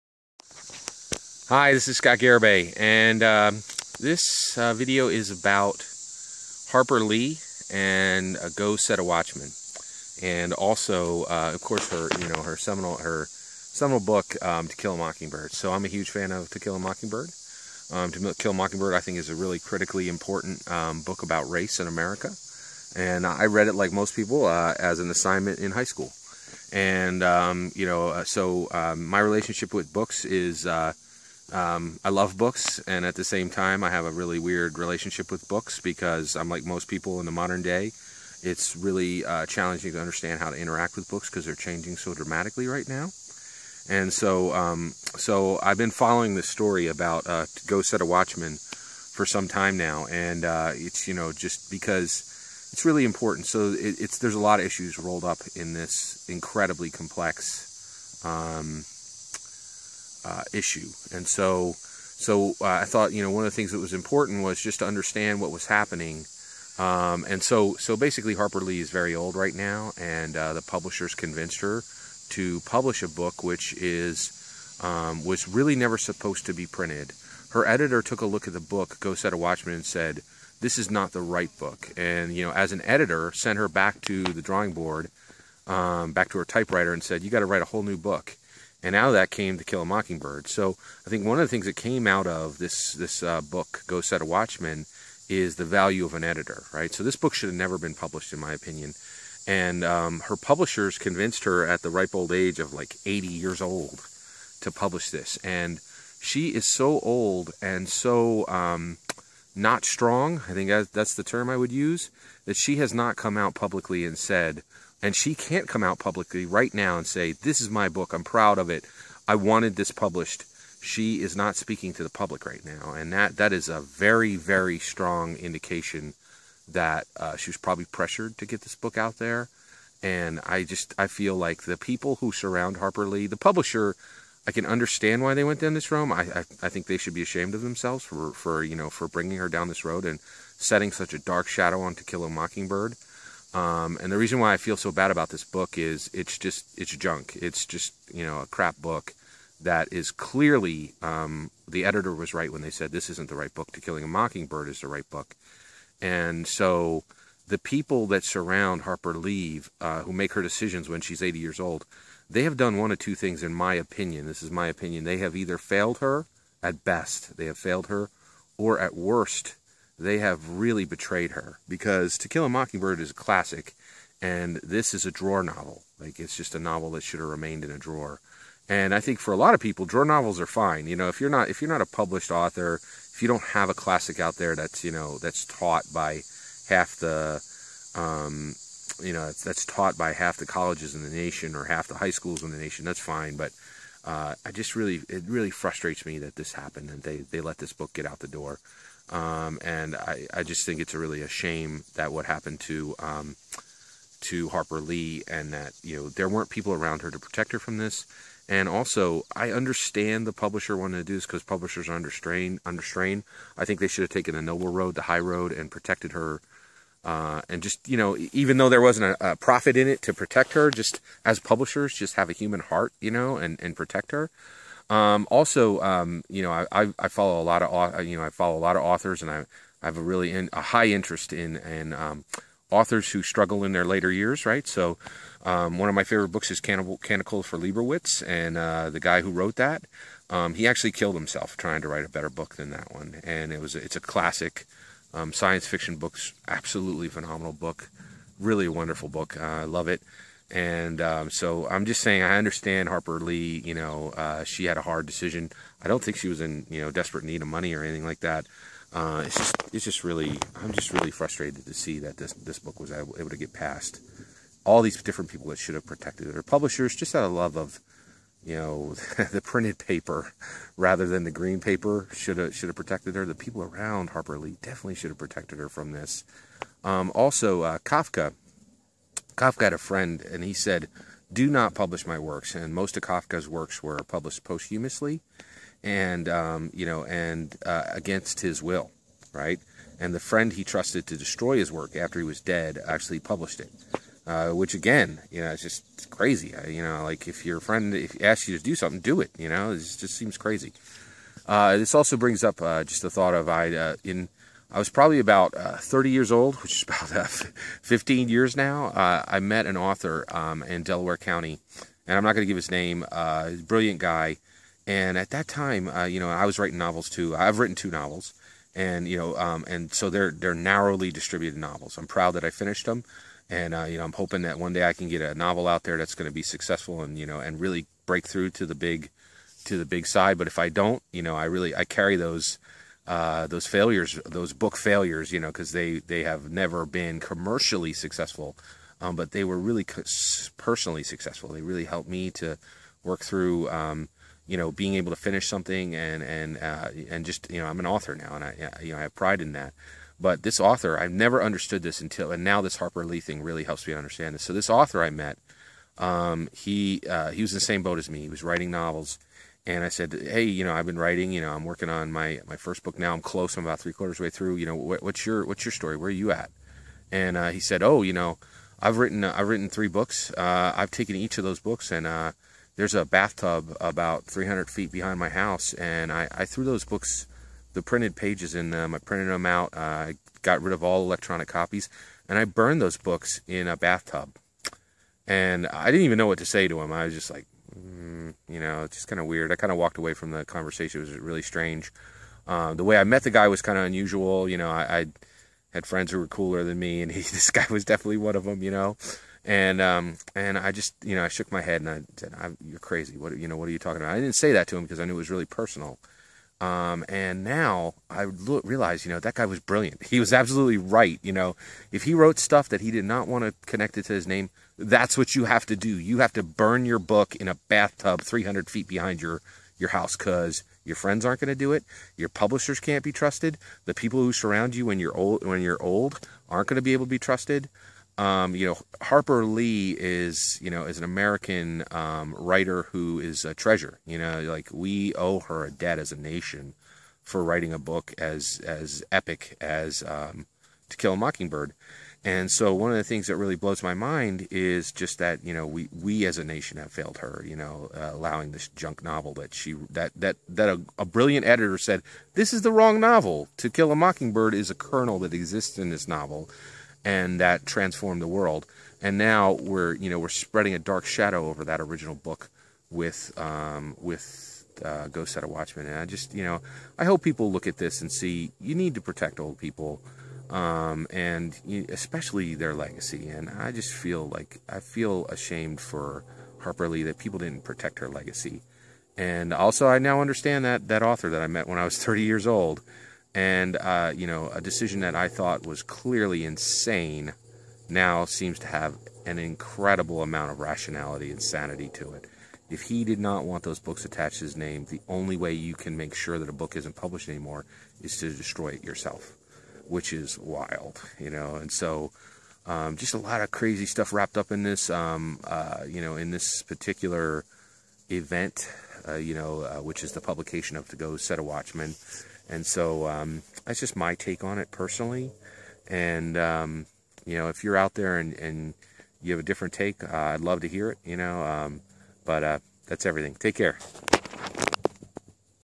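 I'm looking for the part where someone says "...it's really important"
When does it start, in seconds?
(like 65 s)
52 s.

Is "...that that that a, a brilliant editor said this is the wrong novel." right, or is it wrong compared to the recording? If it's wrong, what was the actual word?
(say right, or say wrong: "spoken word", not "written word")
right.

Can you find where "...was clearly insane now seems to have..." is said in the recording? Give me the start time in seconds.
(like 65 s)
485 s.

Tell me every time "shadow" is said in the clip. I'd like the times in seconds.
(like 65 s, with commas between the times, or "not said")
141 s, 461 s.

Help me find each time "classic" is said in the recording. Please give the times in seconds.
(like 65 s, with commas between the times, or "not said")
173 s, 183 s, 243 s.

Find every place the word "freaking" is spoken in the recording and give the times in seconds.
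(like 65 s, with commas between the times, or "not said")
not said.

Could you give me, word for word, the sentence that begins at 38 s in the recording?
It's really uh, challenging to understand how to interact with books because they're changing so dramatically right now.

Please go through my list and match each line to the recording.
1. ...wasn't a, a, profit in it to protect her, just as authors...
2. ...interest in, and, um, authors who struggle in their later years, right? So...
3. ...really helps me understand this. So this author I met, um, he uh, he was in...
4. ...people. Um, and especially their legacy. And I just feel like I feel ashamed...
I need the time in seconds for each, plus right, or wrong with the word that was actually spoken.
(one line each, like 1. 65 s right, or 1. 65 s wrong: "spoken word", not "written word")
1. 218 s wrong: "publishers", not "authors"
2. 230 s right
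3. 353 s right
4. 469 s right.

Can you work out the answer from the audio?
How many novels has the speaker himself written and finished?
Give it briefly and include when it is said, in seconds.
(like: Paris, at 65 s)
2, at 317 s.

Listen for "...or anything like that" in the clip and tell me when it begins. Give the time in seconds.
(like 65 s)
257 s.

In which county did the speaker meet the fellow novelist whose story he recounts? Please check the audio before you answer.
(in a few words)
Delaware County.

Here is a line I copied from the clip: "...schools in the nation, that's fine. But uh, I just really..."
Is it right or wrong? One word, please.
right.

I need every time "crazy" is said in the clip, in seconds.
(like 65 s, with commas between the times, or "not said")
296 s, 300 s, 402 s, 503 s.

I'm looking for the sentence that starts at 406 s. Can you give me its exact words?
Um, and now I realize, you know, that guy was brilliant.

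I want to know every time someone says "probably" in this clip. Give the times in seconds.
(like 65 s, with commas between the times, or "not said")
127 s, 304 s.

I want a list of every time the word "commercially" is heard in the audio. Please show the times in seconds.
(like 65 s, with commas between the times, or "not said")
337 s.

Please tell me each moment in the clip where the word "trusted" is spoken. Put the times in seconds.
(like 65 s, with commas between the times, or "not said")
290 s, 423 s, 427 s.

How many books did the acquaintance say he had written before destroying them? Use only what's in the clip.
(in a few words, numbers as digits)
3.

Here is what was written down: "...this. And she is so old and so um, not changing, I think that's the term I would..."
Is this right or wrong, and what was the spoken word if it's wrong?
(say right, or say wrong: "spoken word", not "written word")
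wrong: "strong", not "changing".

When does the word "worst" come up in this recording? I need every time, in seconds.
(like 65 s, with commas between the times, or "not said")
168 s.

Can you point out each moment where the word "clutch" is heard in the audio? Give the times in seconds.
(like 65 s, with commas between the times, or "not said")
not said.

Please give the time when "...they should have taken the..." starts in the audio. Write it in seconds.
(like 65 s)
213 s.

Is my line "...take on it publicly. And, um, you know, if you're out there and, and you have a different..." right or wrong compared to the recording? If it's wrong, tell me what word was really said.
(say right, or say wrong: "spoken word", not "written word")
wrong: "personally", not "publicly".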